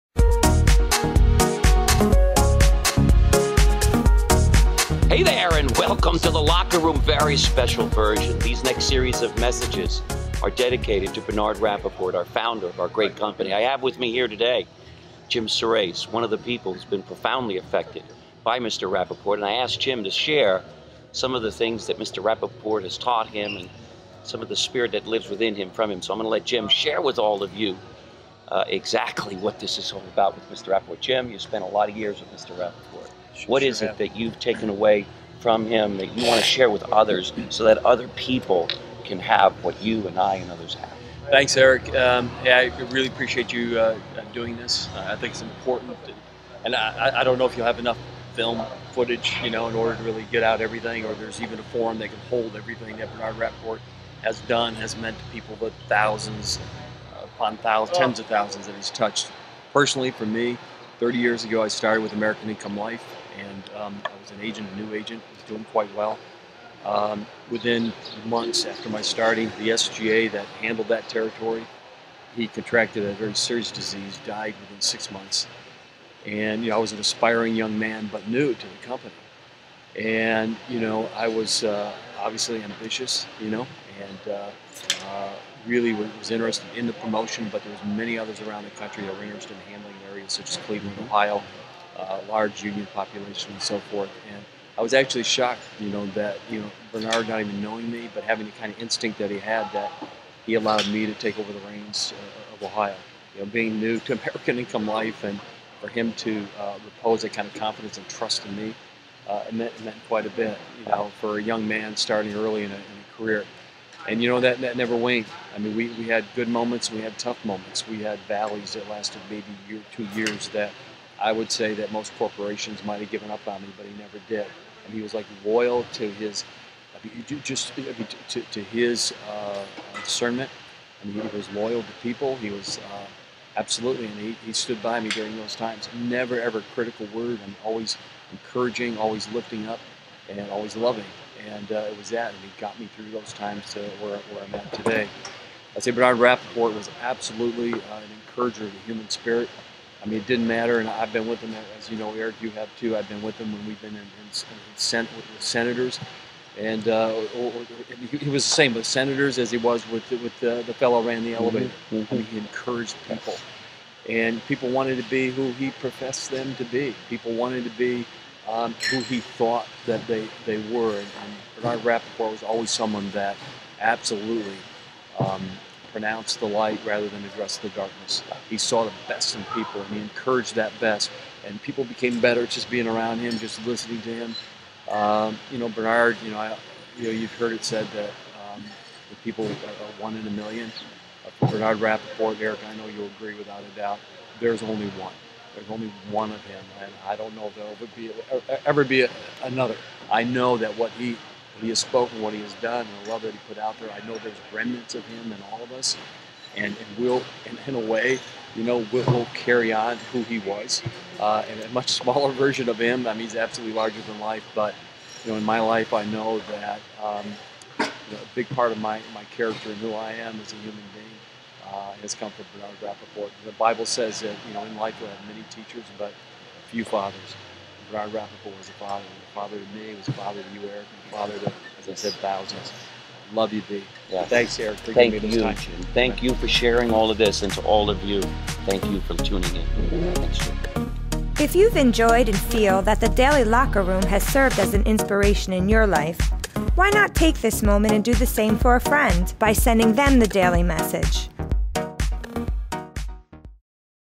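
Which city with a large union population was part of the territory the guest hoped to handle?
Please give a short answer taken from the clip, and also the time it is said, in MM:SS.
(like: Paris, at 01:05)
Cleveland, Ohio, at 01:30.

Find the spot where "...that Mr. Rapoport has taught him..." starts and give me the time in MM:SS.
00:21.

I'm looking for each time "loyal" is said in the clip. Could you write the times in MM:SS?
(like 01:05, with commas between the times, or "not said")
02:05, 02:11.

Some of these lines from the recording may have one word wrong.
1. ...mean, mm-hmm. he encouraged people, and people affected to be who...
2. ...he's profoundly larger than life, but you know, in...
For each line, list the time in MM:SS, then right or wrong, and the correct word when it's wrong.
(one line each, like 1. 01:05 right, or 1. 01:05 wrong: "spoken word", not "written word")
1. 02:41 wrong: "wanted", not "affected"
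2. 03:33 wrong: "absolutely", not "profoundly".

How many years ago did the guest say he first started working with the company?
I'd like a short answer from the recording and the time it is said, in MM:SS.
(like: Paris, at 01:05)
30, at 01:00.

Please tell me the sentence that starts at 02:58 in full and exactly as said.
He saw the best in people and he encouraged that best.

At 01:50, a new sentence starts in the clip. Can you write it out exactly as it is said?
You know, for a young man starting early in a, in a career, and you know that that never waned.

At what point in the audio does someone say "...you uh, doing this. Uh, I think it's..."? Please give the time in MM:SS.
00:43.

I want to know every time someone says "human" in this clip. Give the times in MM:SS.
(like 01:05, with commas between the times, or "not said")
02:28, 03:40.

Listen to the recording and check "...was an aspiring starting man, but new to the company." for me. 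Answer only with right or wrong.
wrong.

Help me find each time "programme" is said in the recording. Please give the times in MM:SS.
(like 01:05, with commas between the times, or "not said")
not said.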